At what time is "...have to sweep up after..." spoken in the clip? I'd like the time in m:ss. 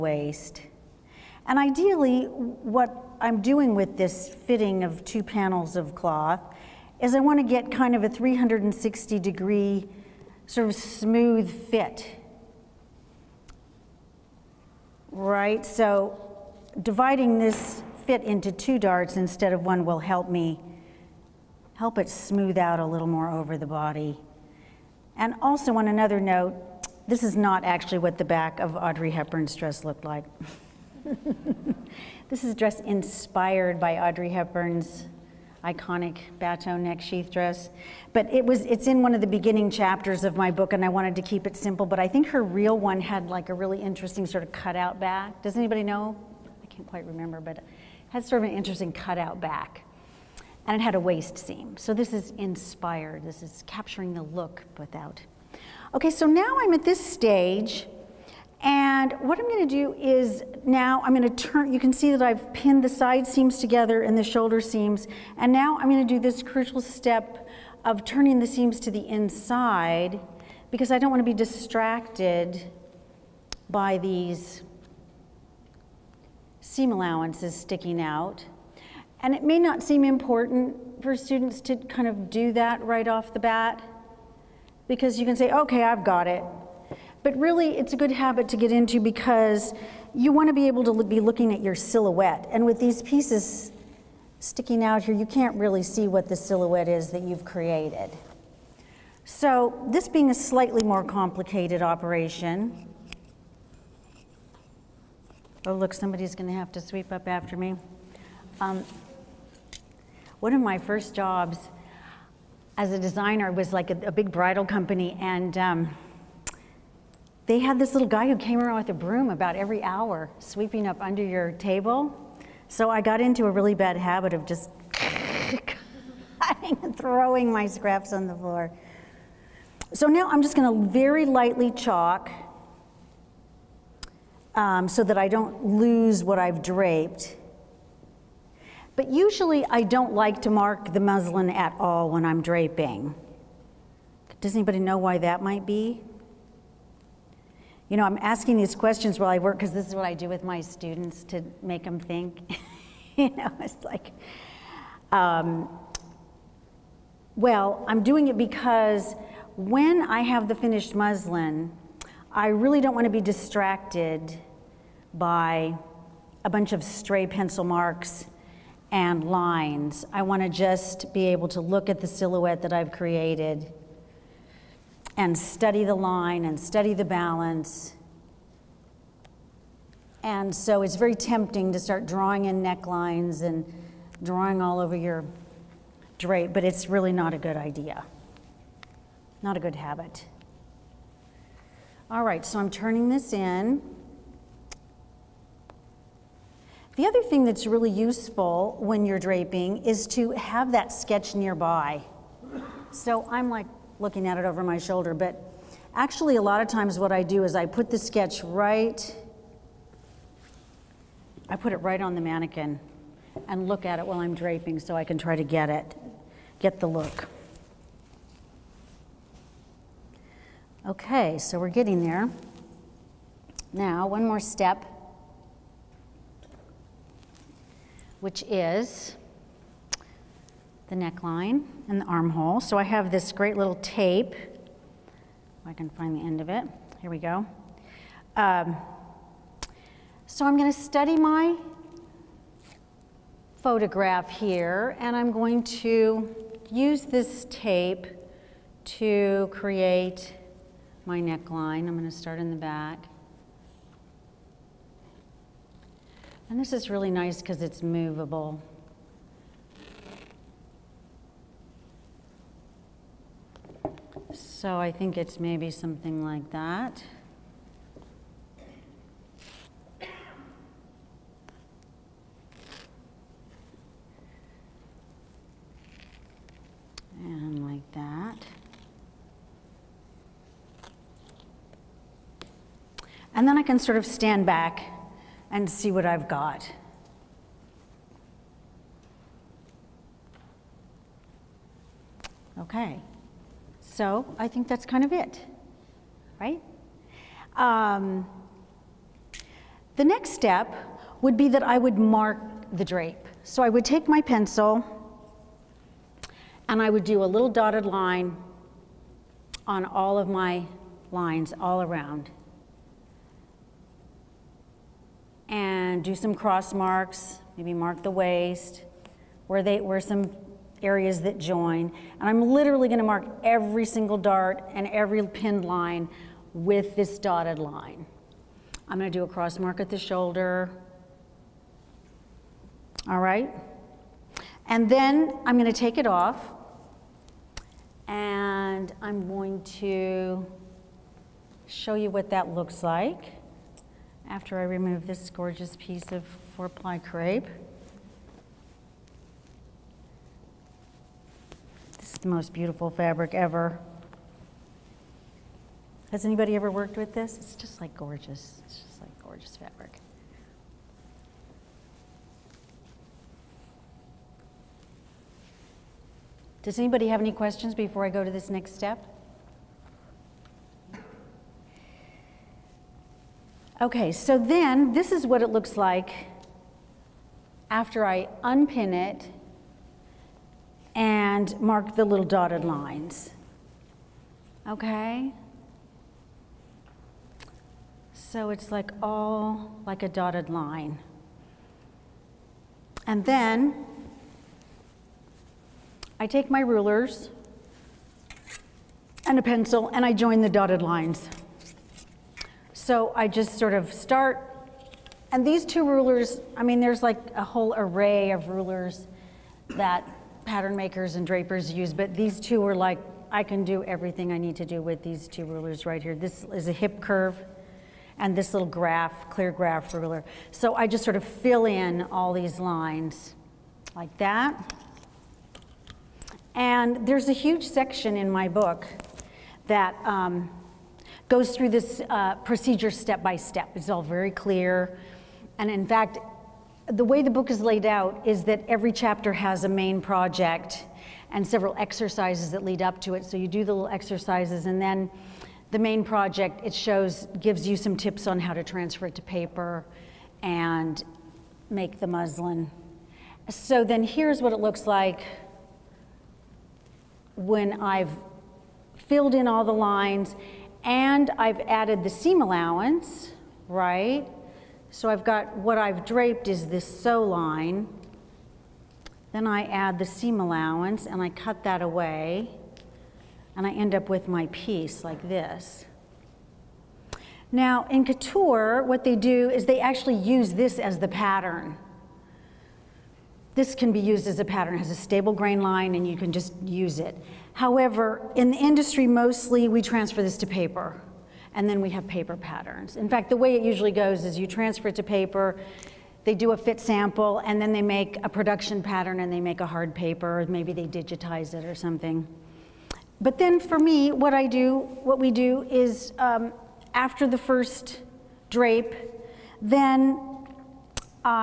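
1:46.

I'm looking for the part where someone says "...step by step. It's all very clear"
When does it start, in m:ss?
7:12.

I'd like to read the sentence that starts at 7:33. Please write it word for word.
So then here's what it looks like when I've filled in all the lines and I've added the seam allowance, right?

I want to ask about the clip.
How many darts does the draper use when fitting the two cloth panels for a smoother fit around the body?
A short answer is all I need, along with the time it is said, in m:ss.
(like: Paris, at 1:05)
2, at 0:18.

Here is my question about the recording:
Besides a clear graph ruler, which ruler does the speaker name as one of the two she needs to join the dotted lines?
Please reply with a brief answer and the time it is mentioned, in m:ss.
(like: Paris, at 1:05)
Hip curve, at 6:56.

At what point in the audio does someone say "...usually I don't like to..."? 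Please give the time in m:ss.
2:19.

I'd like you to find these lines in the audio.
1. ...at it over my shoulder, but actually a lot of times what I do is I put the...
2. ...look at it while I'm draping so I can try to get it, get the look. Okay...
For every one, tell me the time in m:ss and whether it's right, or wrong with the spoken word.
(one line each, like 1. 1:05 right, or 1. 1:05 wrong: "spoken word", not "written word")
1. 3:24 right
2. 3:33 right.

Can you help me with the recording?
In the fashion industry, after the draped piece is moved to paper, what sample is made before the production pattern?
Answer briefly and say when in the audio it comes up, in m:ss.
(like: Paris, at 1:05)
A fit sample, at 8:16.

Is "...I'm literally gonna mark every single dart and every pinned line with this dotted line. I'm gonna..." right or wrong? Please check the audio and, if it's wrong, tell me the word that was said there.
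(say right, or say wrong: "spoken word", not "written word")
right.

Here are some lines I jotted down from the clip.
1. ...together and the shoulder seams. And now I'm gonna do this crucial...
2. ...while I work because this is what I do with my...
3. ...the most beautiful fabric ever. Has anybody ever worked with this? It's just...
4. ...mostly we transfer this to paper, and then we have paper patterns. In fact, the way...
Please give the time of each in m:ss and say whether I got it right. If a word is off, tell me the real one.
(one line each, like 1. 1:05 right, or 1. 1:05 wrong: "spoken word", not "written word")
1. 1:03 right
2. 2:29 right
3. 5:52 right
4. 8:09 right.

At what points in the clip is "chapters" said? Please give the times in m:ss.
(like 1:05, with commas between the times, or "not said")
0:39, 7:18.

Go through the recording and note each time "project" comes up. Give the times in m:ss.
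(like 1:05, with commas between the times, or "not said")
7:20, 7:26.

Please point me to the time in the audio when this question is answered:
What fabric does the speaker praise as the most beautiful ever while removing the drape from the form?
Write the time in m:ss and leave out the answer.
5:46.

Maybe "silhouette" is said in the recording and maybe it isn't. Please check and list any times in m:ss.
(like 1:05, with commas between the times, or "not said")
1:31, 1:36, 2:52.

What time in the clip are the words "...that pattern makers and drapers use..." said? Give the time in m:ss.
6:49.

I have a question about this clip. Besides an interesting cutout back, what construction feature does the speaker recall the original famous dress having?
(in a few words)
A waist seam.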